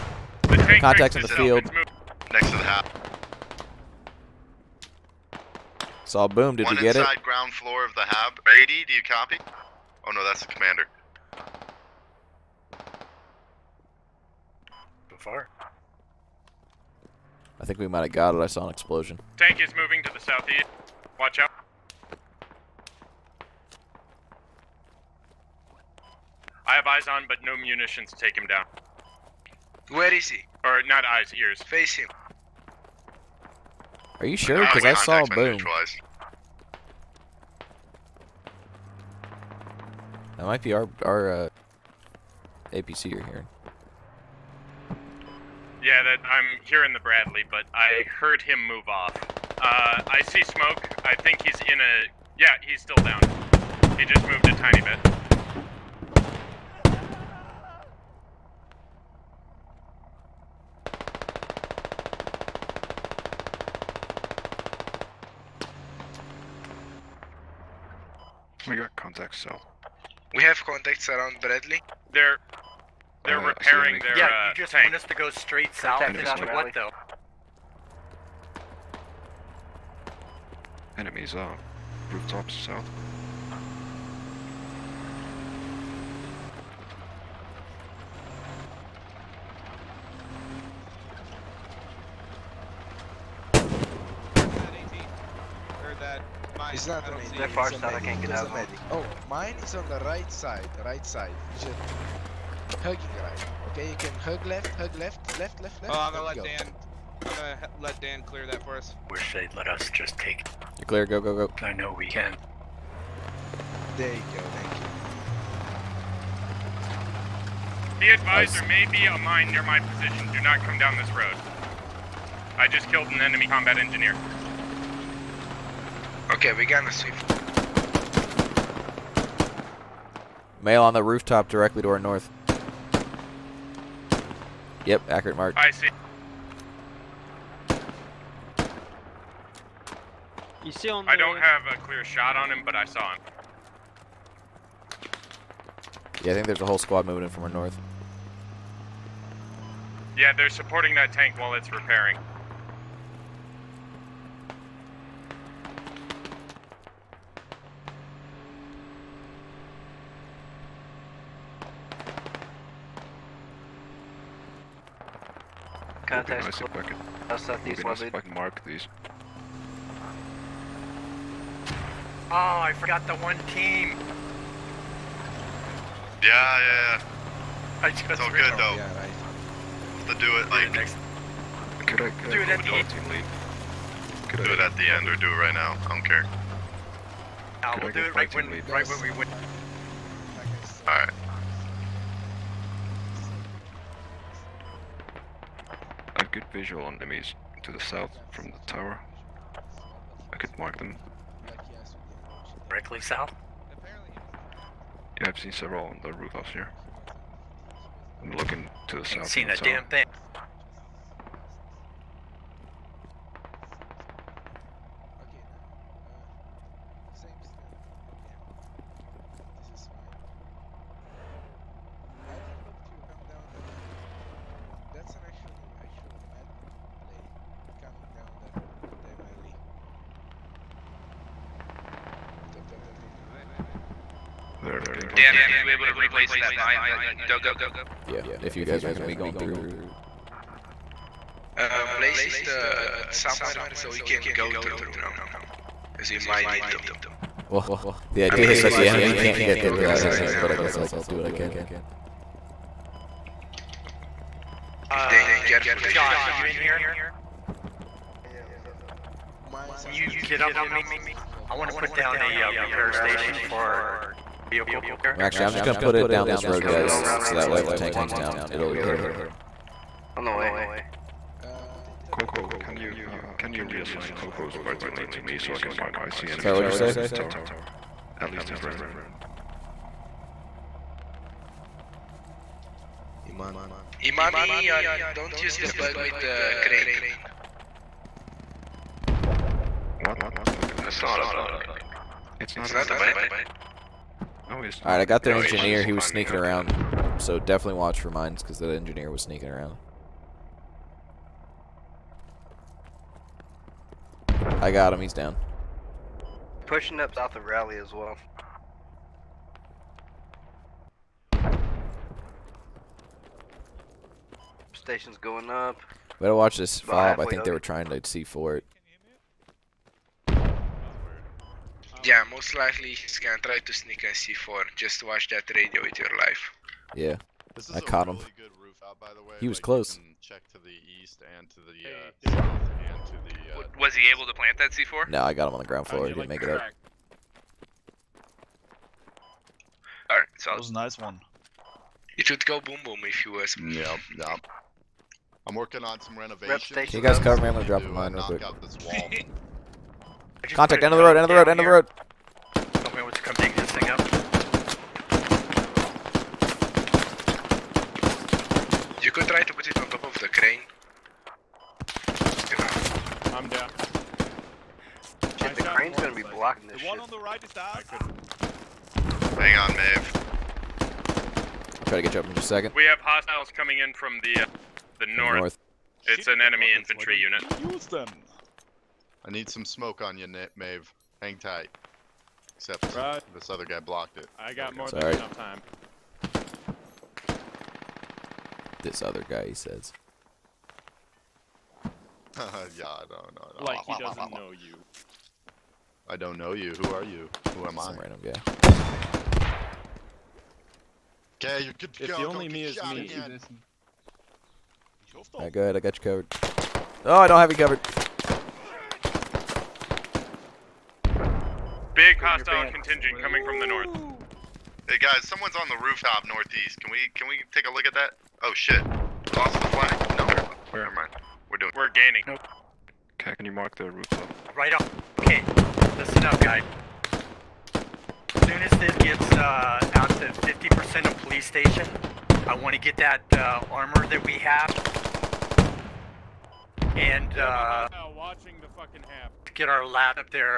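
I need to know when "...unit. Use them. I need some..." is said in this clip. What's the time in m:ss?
6:17.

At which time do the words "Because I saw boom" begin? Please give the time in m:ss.
0:34.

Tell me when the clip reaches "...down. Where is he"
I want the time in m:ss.
0:28.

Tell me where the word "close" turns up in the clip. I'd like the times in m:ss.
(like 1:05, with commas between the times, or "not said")
2:46, 5:29.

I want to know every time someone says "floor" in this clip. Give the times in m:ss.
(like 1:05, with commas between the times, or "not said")
0:07, 5:35.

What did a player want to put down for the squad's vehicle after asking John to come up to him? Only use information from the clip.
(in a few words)
repair station.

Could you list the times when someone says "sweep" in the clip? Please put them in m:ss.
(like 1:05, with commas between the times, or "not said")
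2:06.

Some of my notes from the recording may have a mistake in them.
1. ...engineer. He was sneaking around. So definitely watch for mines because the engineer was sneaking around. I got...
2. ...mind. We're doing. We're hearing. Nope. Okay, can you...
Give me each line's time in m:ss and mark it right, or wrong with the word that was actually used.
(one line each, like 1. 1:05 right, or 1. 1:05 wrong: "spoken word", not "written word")
1. 4:55 right
2. 7:00 wrong: "gaining", not "hearing".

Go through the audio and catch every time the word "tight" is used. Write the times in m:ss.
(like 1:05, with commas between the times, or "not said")
6:21.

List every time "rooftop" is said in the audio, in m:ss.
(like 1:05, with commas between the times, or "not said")
1:22, 2:11, 3:26, 6:55, 7:03.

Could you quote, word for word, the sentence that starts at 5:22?
Yeah, most likely he's gonna try to sneak in C4.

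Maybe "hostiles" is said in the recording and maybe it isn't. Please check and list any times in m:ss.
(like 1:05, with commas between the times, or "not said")
6:12, 6:52.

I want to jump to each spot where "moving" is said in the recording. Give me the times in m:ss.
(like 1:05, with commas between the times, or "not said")
0:19, 2:27.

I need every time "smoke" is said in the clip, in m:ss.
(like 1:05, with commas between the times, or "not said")
0:50, 6:19.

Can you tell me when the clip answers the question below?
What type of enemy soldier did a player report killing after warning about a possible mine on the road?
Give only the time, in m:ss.
2:03.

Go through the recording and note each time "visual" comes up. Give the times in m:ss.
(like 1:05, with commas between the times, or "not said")
3:16.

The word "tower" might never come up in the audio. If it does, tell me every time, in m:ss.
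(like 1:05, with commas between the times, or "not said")
3:18, 4:37.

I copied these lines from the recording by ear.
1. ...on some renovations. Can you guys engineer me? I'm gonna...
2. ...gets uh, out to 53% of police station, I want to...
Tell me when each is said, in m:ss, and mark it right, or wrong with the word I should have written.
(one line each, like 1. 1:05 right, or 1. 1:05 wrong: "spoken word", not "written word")
1. 5:45 wrong: "cover", not "engineer"
2. 7:08 wrong: "50", not "53".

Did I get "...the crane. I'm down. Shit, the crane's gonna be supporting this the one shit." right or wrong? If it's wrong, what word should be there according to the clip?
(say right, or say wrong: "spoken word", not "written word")
wrong: "blocking", not "supporting".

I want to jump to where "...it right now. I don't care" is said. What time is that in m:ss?
3:05.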